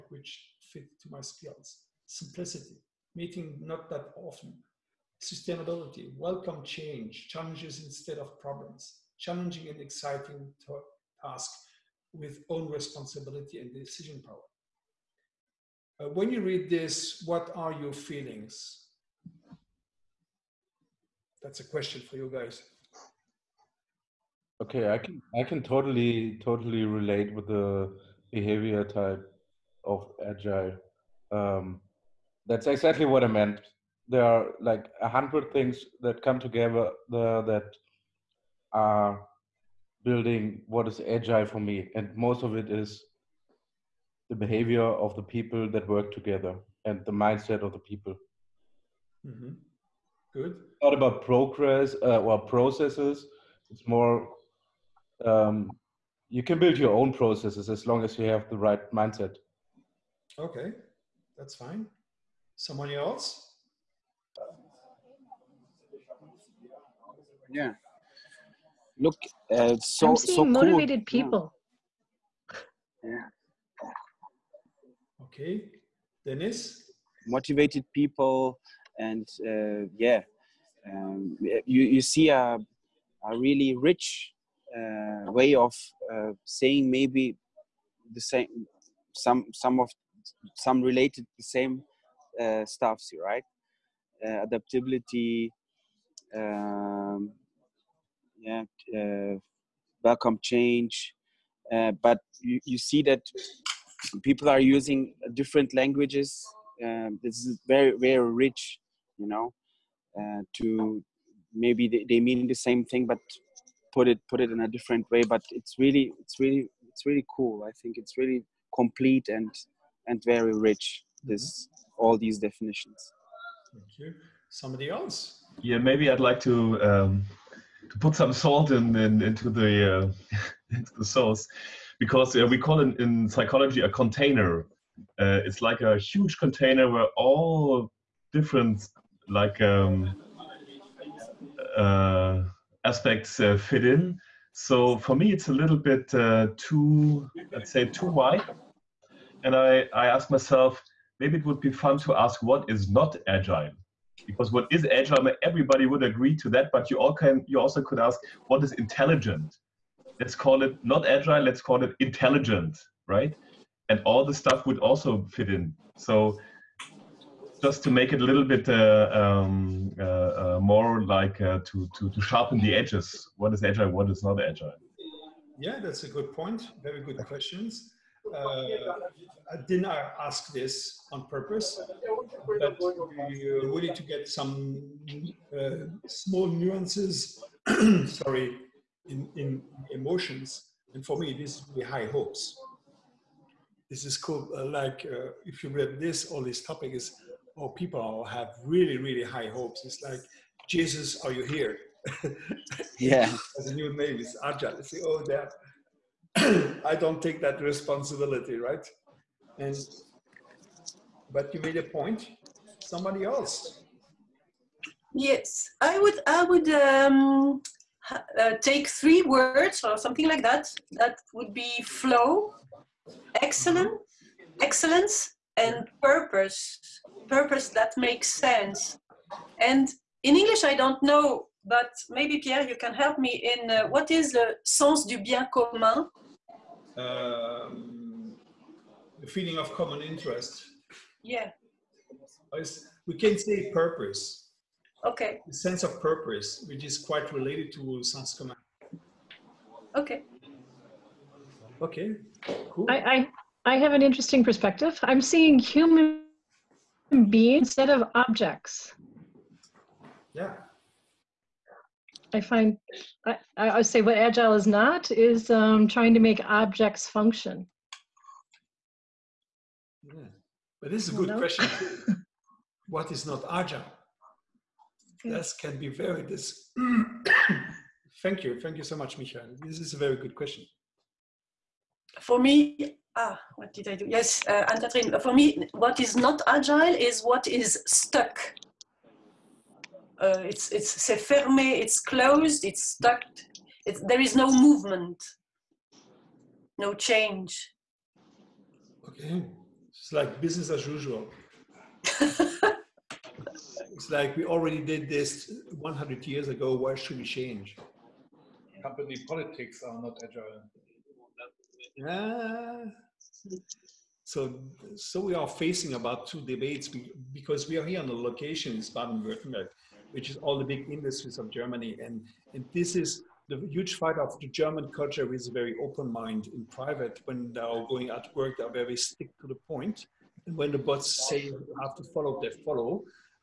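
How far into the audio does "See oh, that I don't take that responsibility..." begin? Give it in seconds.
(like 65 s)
204 s.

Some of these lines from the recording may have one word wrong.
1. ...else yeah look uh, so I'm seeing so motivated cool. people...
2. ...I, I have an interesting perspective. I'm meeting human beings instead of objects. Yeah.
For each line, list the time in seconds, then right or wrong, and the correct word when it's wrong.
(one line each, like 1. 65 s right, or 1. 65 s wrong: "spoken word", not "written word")
1. 62 s right
2. 252 s wrong: "seeing", not "meeting".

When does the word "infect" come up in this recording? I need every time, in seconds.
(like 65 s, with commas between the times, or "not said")
not said.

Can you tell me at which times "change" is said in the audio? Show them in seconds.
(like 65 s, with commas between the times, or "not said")
6 s, 100 s, 296 s, 307 s.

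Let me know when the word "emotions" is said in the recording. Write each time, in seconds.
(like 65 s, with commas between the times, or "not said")
189 s.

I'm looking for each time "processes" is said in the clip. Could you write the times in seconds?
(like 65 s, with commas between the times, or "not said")
52 s, 57 s.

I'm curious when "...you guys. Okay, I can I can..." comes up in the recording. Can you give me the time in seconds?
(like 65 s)
22 s.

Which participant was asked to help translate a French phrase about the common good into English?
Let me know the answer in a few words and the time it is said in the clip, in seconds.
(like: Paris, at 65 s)
Pierre, at 232 s.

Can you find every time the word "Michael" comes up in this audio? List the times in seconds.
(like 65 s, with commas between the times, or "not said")
279 s.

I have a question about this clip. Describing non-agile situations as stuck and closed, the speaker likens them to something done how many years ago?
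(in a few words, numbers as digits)
100.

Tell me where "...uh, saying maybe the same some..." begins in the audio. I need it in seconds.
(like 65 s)
86 s.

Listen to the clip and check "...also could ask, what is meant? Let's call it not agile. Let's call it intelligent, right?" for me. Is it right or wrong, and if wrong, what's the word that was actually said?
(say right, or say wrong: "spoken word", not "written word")
wrong: "intelligent", not "meant".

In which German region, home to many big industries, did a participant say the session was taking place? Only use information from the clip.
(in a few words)
Baden-Württemberg.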